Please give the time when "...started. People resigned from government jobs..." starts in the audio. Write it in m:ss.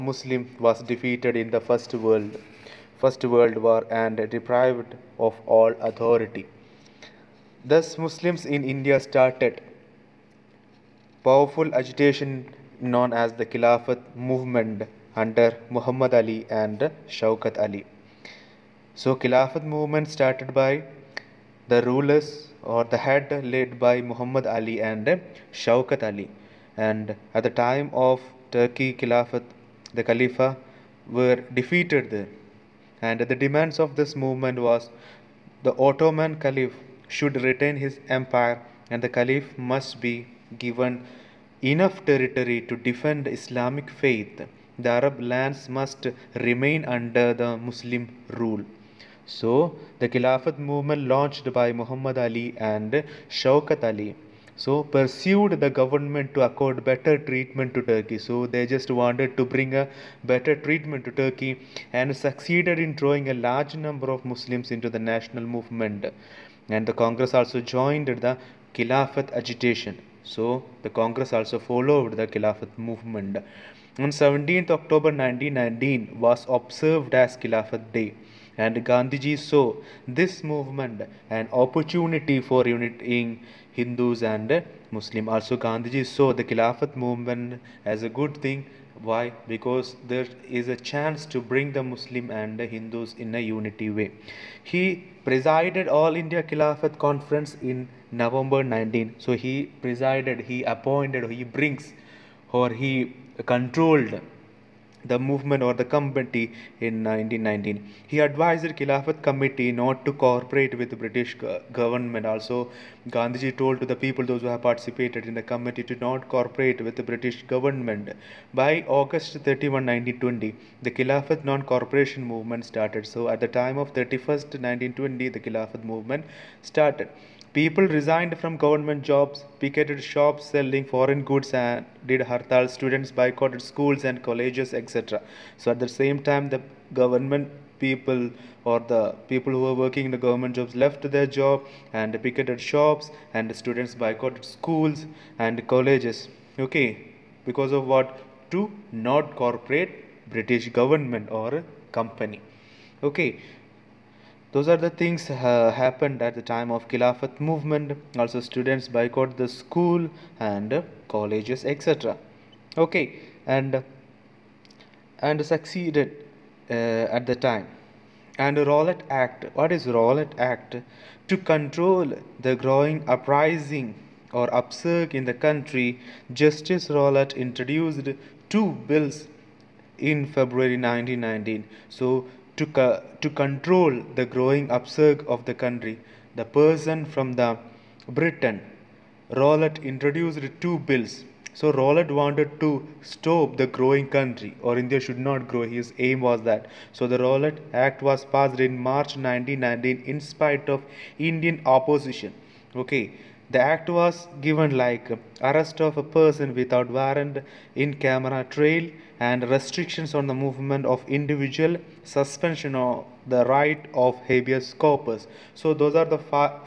2:06.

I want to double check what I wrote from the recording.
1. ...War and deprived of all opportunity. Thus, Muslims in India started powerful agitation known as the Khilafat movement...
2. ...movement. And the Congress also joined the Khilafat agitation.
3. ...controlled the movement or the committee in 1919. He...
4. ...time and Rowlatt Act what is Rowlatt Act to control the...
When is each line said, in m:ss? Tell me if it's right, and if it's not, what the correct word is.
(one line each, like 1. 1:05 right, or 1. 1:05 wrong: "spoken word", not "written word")
1. 0:03 wrong: "authority", not "opportunity"
2. 1:05 right
3. 1:43 right
4. 2:47 right.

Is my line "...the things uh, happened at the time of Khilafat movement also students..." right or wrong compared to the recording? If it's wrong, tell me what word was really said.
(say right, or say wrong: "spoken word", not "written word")
right.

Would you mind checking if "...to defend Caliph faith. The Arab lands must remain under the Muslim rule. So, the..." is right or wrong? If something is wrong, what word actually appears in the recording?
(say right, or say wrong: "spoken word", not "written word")
wrong: "Islamic", not "Caliph".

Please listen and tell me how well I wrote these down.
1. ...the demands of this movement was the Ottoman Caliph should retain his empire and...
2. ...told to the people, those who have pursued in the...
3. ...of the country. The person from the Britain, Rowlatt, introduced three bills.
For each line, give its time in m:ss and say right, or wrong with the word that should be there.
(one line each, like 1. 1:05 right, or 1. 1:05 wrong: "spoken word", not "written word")
1. 0:33 right
2. 1:53 wrong: "participated", not "pursued"
3. 3:05 wrong: "two", not "three".